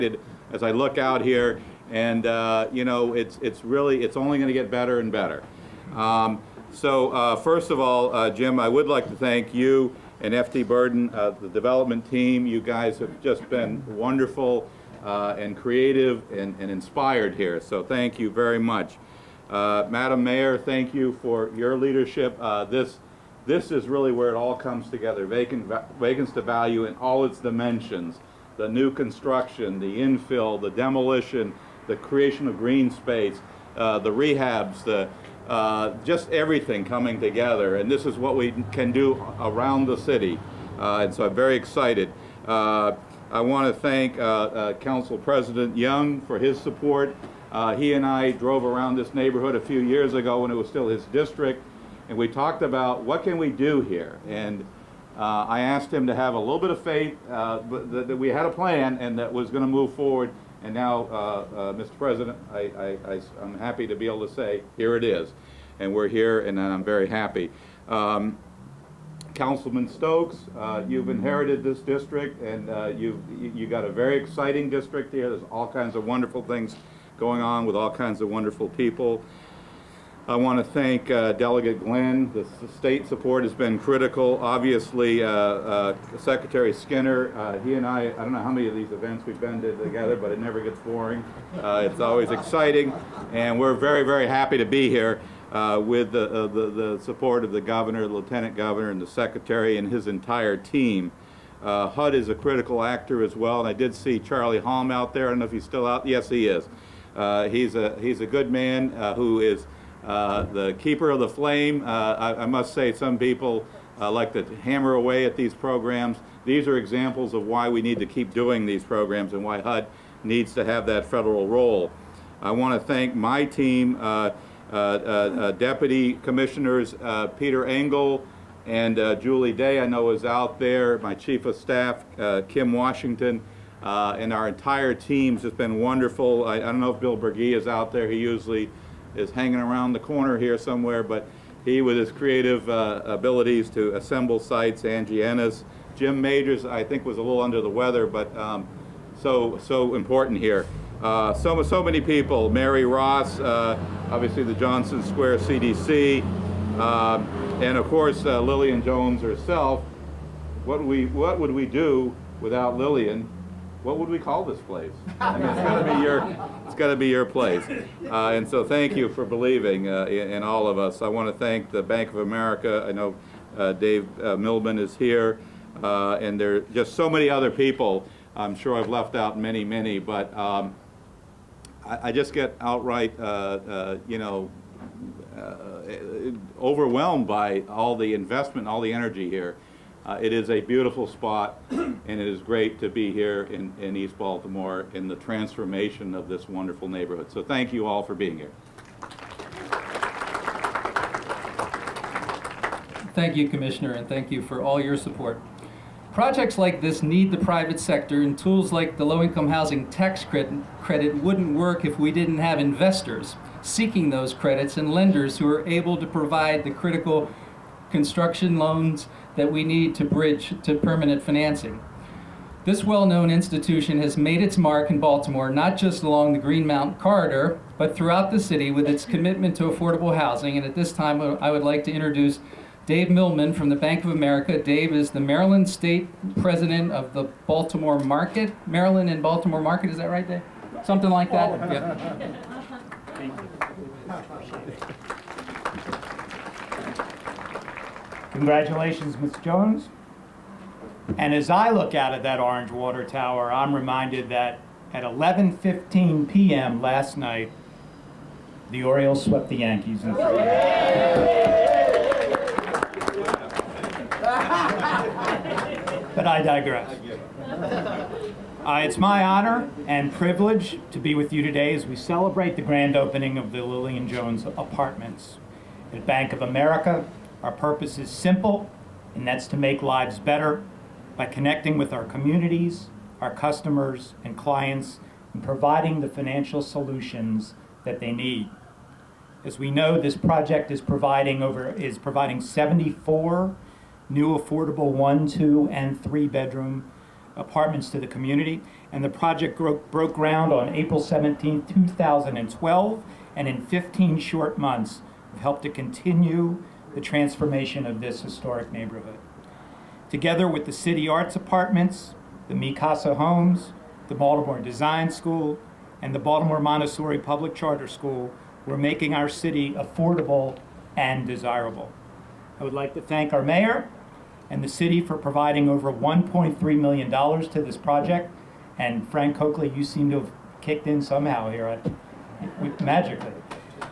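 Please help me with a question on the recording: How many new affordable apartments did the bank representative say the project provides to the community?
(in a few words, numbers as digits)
74.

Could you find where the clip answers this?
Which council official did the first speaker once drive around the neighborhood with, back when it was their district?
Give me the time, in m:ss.
0:44.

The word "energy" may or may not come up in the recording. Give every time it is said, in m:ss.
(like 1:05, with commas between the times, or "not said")
3:08.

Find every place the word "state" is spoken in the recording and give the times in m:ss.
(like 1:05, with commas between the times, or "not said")
1:22, 3:55.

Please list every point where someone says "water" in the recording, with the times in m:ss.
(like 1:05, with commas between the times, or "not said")
4:12.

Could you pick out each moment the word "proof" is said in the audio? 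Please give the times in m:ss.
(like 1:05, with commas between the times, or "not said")
not said.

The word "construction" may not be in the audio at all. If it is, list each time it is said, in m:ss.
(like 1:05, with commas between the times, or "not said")
0:28, 3:37.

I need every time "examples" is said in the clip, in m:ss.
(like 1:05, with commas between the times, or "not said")
1:56.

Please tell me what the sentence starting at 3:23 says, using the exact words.
Thank you, Commissioner, and thank you for all your support.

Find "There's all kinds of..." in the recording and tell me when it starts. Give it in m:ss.
1:15.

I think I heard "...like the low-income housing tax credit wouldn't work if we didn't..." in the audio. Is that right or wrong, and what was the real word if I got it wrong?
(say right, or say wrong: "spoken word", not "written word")
right.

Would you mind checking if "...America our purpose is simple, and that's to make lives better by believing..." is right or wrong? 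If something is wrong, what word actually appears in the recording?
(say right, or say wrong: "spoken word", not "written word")
wrong: "connecting", not "believing".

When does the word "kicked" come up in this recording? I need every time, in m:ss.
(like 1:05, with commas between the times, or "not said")
5:30.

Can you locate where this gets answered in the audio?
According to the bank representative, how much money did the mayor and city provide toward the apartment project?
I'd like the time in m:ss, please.
5:25.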